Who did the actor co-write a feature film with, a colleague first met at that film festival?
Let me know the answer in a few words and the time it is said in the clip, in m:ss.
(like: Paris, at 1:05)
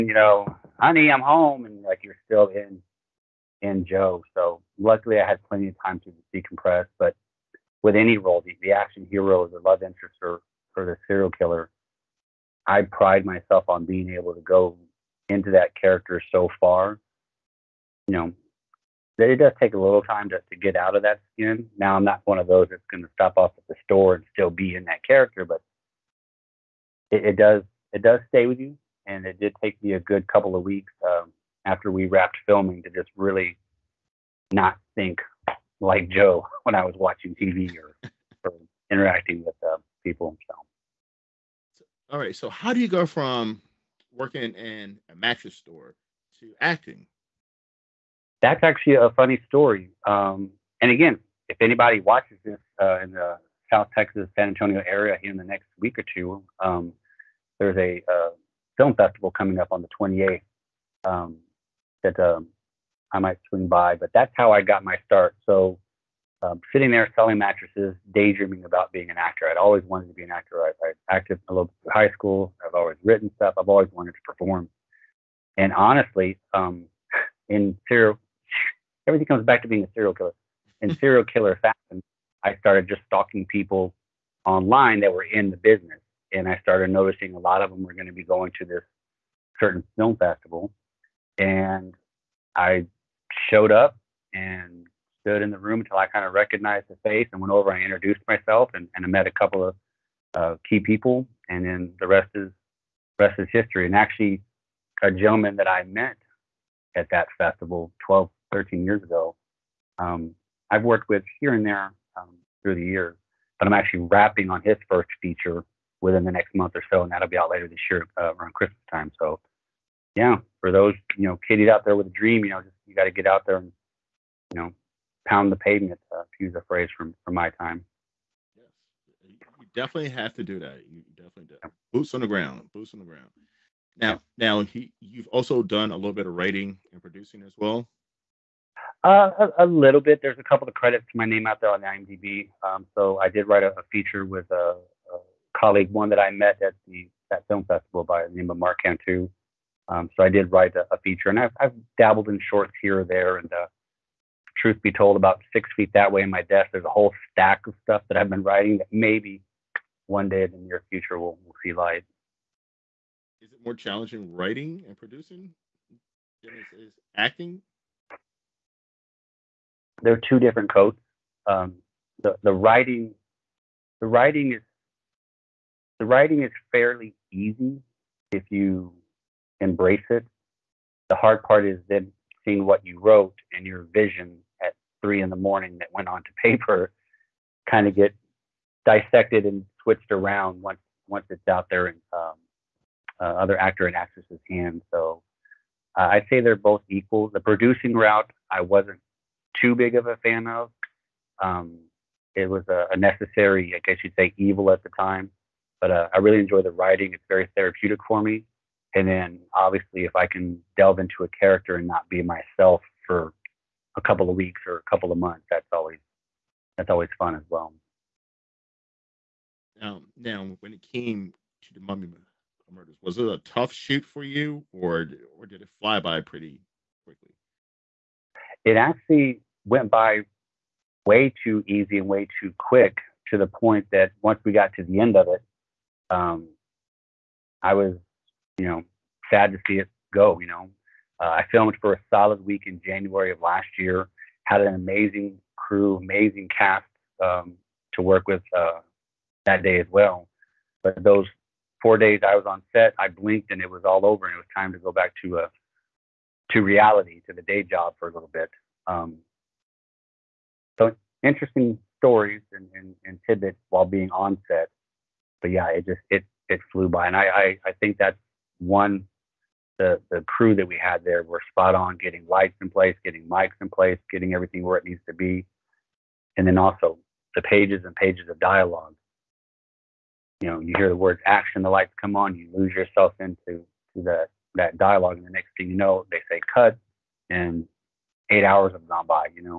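Mark Cantu, at 2:28.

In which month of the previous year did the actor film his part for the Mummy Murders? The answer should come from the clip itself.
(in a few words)
January.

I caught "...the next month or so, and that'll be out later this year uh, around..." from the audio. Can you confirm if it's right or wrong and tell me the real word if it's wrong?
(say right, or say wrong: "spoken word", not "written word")
right.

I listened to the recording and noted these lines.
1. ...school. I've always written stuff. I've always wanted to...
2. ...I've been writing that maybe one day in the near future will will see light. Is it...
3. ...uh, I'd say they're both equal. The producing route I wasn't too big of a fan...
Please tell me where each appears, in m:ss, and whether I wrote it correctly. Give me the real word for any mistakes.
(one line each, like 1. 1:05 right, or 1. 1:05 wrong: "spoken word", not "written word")
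1. 1:12 right
2. 2:38 right
3. 3:15 right.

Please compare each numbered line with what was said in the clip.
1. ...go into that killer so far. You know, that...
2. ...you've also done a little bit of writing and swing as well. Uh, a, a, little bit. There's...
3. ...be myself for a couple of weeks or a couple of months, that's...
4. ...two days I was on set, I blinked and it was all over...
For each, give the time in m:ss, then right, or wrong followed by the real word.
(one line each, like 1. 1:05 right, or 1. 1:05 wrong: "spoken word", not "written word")
1. 0:14 wrong: "character", not "killer"
2. 2:14 wrong: "producing", not "swing"
3. 3:32 right
4. 4:11 wrong: "four", not "two".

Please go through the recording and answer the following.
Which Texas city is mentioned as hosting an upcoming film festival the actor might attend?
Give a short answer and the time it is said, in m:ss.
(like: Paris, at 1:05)
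San Antonio, at 0:54.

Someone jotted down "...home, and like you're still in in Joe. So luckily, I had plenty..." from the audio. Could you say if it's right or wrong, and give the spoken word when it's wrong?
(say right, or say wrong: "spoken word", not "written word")
right.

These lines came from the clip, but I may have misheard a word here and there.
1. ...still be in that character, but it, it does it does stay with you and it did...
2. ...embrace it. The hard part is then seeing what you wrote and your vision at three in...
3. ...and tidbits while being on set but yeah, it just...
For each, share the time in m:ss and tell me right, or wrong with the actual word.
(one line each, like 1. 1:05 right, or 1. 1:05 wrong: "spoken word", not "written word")
1. 0:24 right
2. 2:59 right
3. 4:23 right.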